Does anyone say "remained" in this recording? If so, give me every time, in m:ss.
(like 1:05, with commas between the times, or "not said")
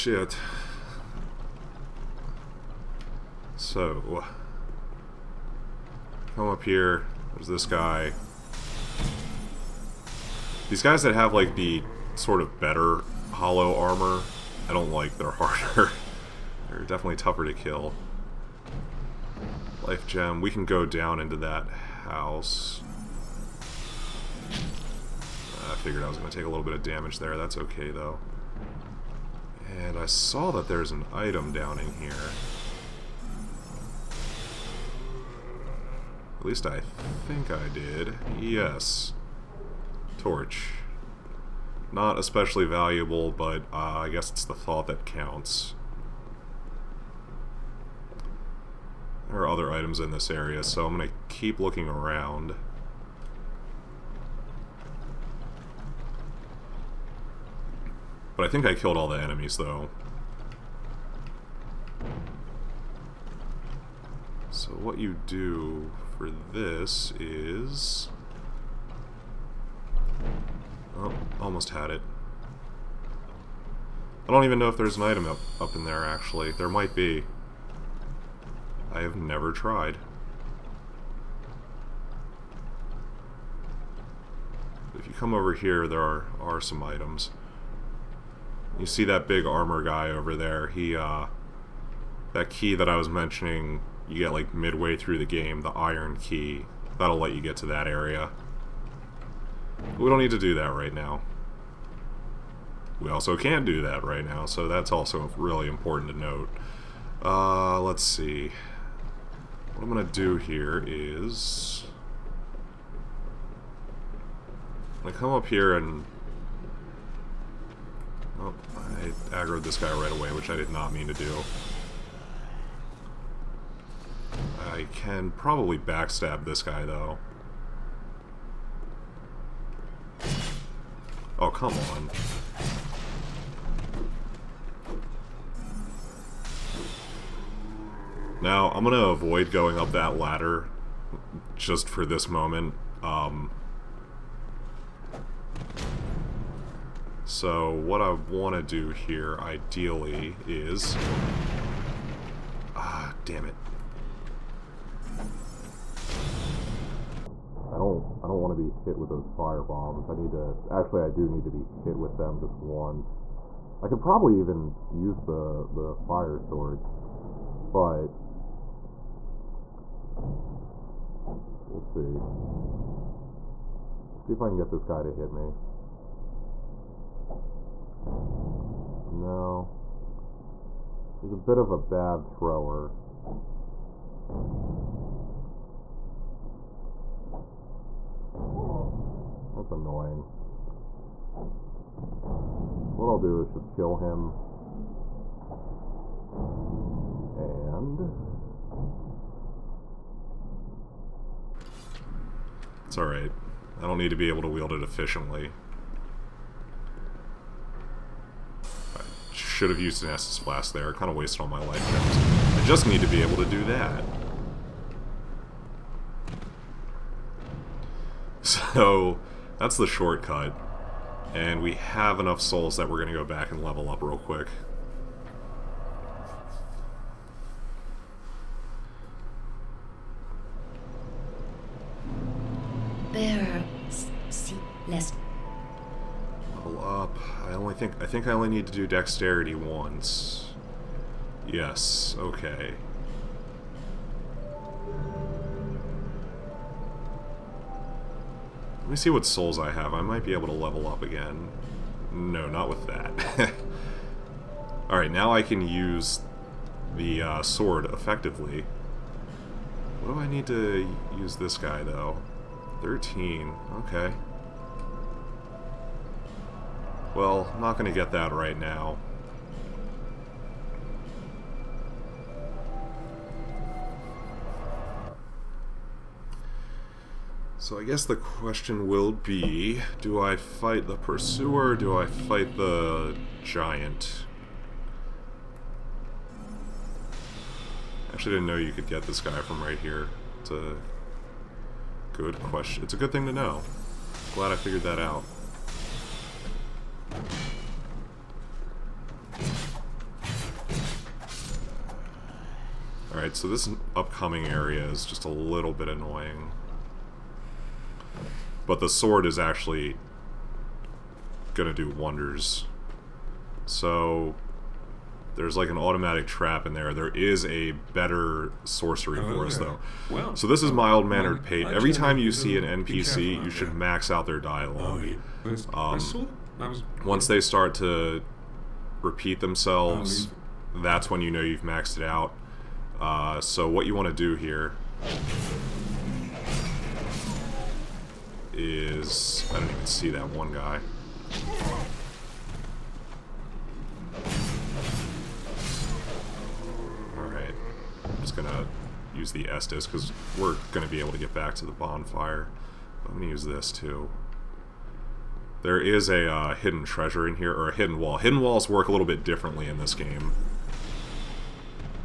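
not said.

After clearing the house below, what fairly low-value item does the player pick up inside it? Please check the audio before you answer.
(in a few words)
Torch.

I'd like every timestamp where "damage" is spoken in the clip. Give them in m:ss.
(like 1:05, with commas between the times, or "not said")
0:26.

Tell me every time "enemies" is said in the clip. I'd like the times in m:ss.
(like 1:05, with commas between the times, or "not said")
0:59.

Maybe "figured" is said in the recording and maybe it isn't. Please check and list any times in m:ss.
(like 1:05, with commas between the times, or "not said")
0:25, 4:54.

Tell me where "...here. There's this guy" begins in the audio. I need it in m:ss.
0:06.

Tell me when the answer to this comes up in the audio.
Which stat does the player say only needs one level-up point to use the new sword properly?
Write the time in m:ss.
3:58.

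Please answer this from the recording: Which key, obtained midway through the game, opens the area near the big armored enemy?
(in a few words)
iron key.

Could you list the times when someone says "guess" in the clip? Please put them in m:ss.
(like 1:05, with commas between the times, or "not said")
0:44, 4:37.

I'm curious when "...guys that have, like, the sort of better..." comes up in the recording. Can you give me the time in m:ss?
0:10.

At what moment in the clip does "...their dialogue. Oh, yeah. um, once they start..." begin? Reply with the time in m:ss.
5:24.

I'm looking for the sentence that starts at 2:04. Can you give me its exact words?
I can probably backstab this guy, though.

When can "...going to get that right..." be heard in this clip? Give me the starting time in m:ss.
4:27.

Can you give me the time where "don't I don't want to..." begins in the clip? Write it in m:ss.
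2:37.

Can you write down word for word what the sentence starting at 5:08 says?
But the sword is actually gonna do wonders.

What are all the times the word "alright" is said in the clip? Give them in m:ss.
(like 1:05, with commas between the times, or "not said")
3:22, 4:14, 5:03, 5:47.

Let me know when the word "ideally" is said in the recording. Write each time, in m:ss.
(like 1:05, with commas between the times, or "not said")
2:29.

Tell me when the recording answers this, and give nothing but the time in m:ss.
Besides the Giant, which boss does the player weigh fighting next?
4:40.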